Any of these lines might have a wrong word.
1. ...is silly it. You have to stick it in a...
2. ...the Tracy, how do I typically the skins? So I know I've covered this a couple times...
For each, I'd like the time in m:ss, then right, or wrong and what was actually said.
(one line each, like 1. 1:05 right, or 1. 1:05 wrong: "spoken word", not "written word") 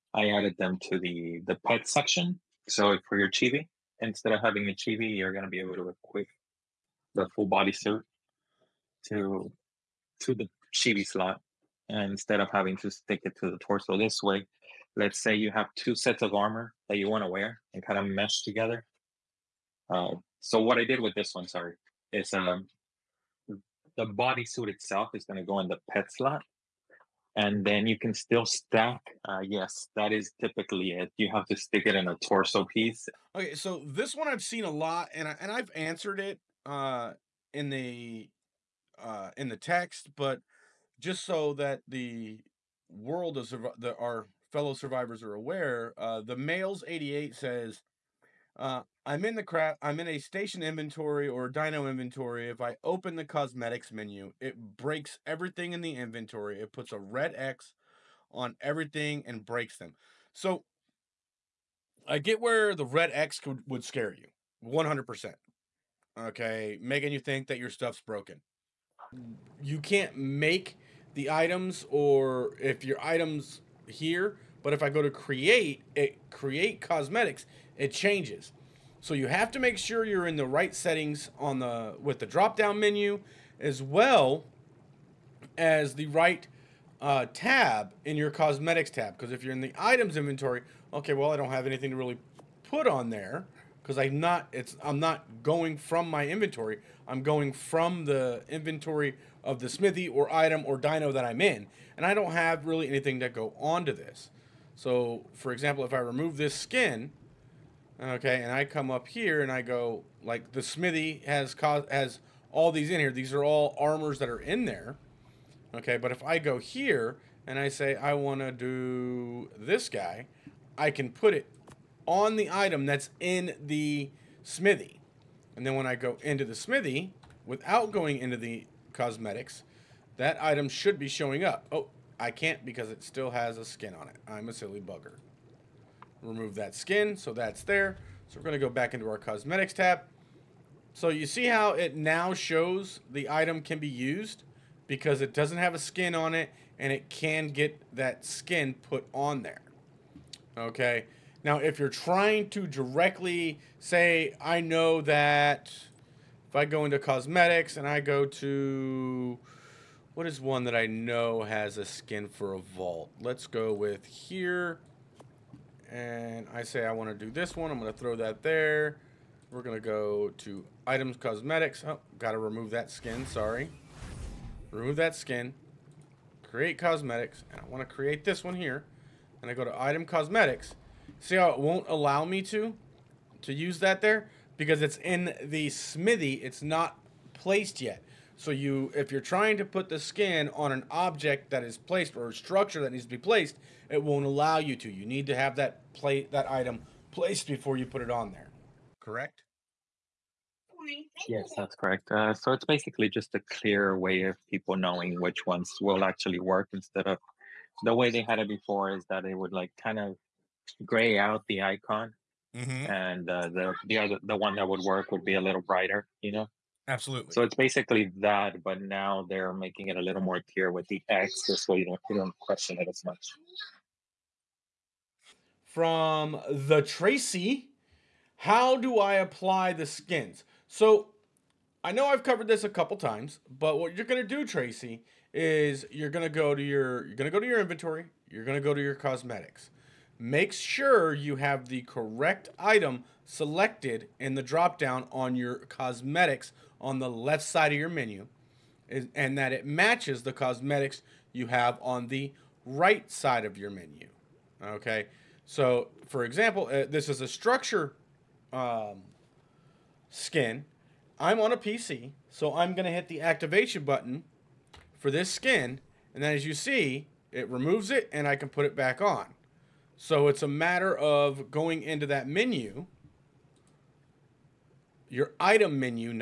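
1. 0:30 wrong: "typically", not "silly"
2. 3:46 wrong: "apply", not "typically".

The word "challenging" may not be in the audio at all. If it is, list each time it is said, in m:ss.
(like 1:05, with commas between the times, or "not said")
not said.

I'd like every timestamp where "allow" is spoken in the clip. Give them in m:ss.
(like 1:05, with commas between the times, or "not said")
3:01, 3:14.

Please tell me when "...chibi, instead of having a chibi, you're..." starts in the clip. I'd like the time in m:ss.
0:03.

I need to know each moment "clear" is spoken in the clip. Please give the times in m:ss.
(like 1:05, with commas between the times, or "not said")
3:23, 3:40.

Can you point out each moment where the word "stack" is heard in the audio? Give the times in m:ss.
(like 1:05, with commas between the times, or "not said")
0:28.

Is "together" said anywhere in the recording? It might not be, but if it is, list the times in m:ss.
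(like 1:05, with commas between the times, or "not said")
0:18.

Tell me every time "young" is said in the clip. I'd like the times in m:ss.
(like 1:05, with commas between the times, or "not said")
not said.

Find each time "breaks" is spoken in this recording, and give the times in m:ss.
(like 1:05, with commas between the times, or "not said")
0:54, 0:59.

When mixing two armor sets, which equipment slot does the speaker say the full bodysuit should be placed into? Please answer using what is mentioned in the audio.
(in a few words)
Pet slot.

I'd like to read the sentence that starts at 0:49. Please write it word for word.
I'm in a station inventory or dino inventory.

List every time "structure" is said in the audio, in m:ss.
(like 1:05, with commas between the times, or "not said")
3:12, 4:17.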